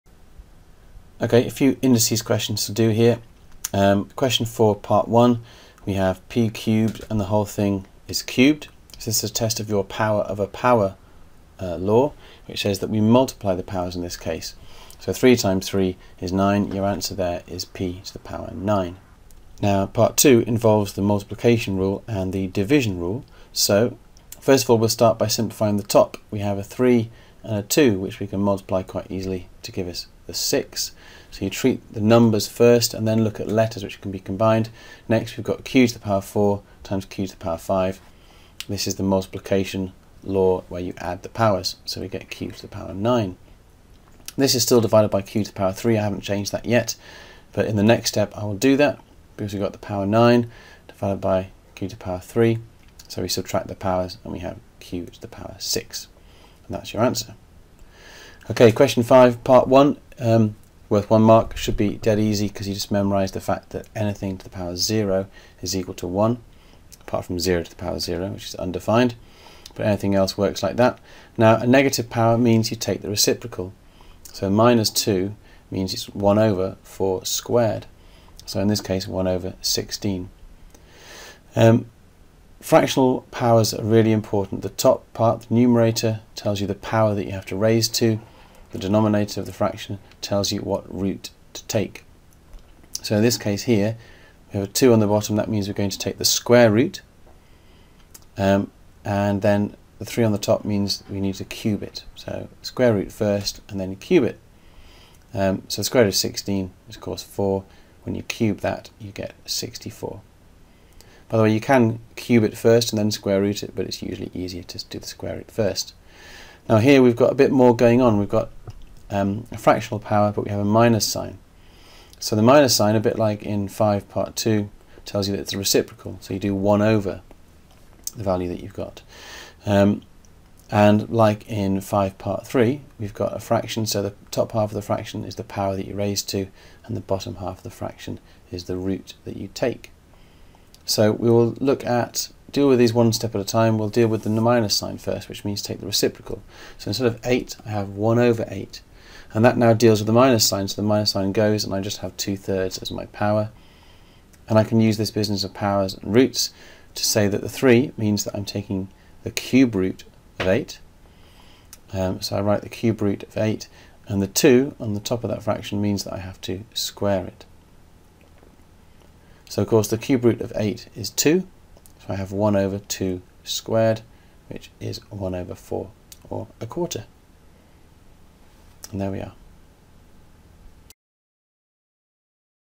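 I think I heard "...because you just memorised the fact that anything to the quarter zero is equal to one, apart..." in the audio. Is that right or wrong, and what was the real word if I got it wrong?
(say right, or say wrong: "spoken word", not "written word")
wrong: "power", not "quarter".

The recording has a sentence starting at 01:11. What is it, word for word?
Now, a negative power means you take the reciprocal.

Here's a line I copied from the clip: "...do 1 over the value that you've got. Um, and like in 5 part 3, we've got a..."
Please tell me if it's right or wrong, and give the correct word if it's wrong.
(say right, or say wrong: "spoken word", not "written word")
right.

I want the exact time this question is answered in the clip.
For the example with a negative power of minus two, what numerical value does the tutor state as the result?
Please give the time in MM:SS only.
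01:19.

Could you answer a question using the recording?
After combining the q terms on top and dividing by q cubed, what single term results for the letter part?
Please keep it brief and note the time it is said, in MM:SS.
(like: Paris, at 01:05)
q to the power 6, at 00:54.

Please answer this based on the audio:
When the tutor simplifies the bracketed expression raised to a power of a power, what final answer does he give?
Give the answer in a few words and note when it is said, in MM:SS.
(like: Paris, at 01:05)
p to the power 9, at 00:17.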